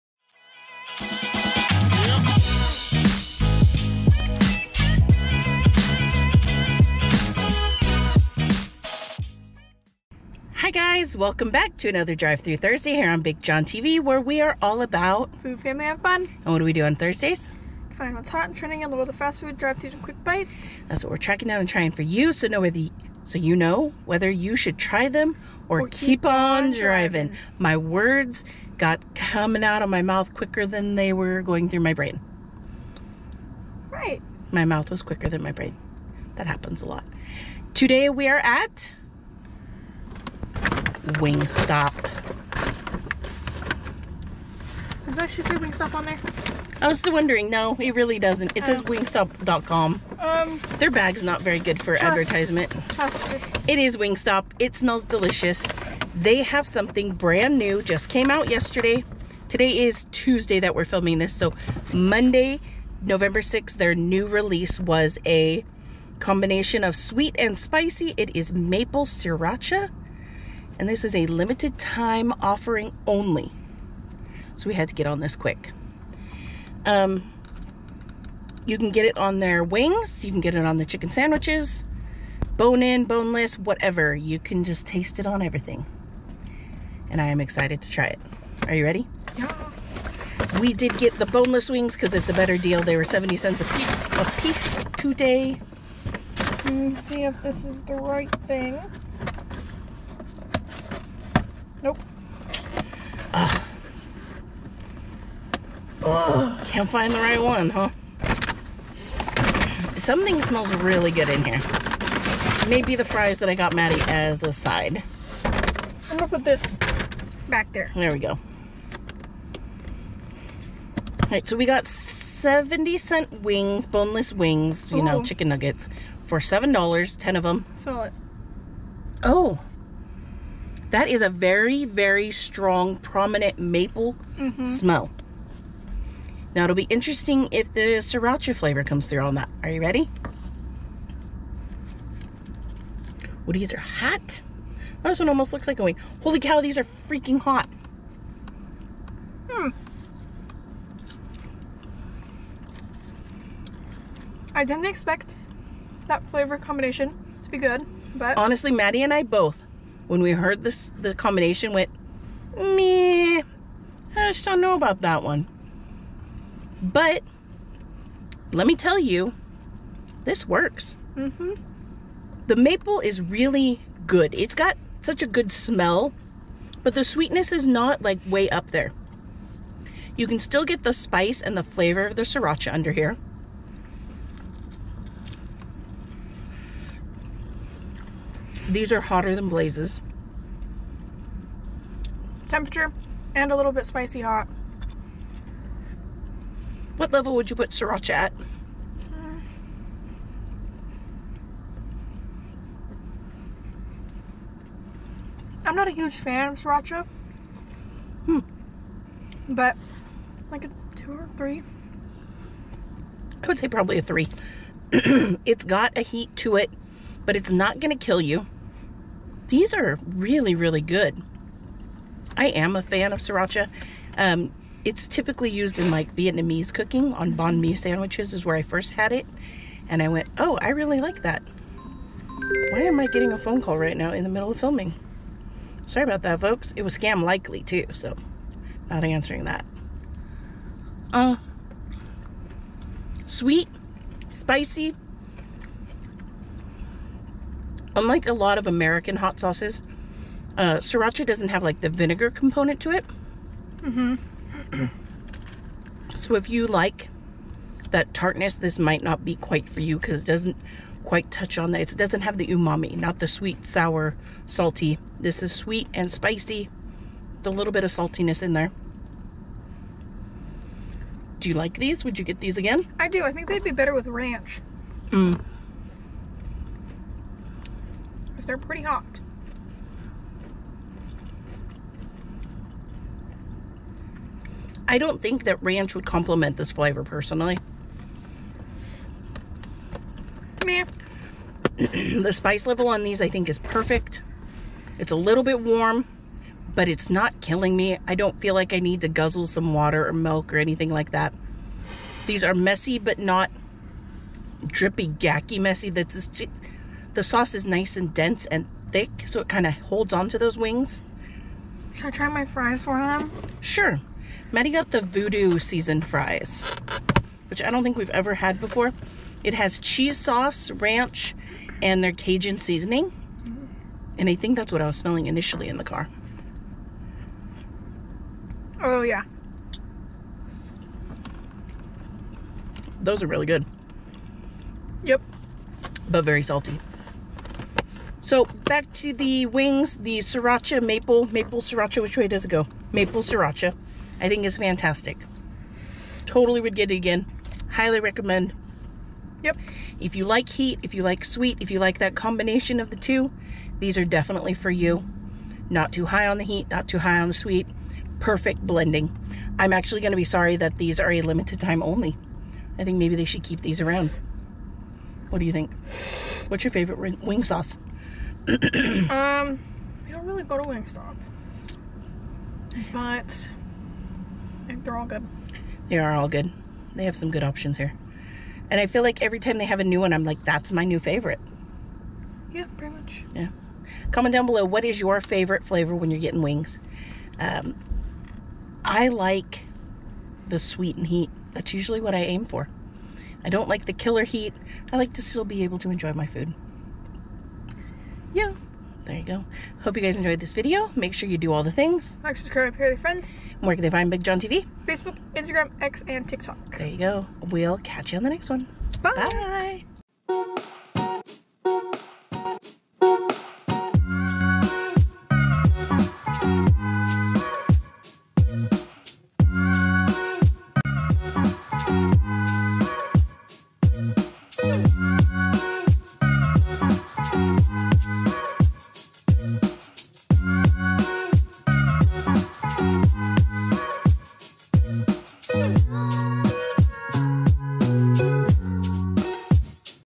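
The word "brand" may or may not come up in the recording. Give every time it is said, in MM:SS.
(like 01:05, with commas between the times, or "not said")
00:57.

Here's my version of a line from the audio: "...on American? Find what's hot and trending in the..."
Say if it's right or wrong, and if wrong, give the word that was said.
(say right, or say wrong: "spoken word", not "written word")
wrong: "Thursdays", not "American".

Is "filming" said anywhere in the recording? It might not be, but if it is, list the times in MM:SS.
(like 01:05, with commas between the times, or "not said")
01:00, 03:54.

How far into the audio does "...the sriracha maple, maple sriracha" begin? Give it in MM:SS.
05:39.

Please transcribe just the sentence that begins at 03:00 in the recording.
You can still get the spice and the flavor of the sriracha under here.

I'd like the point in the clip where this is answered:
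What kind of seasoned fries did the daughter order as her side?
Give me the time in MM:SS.
05:14.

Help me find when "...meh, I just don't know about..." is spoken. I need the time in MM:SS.
02:42.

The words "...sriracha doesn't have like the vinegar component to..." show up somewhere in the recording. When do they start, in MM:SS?
04:10.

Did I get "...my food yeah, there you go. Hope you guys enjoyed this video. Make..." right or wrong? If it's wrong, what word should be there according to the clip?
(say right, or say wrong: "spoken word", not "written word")
right.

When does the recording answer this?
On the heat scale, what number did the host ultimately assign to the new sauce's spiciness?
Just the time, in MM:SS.
03:33.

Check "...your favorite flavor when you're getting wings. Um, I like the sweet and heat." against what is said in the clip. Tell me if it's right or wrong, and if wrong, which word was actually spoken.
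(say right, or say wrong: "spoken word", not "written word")
right.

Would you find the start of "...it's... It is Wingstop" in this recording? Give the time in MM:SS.
00:53.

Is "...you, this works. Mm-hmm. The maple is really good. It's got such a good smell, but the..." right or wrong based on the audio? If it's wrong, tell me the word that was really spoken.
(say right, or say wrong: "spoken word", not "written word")
right.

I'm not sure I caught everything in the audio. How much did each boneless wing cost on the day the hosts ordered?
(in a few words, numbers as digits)
70 cents.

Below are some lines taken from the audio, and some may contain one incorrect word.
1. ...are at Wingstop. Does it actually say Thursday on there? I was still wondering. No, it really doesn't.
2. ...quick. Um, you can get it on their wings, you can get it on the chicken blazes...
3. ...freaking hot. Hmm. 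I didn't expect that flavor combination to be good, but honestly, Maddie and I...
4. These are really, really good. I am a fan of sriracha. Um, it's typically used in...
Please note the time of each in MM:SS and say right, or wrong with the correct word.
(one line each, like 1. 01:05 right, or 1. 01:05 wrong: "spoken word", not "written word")
1. 00:38 wrong: "Wingstop", not "Thursday"
2. 01:15 wrong: "sandwiches", not "blazes"
3. 02:27 right
4. 03:39 right.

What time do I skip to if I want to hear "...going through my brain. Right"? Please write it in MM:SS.
00:31.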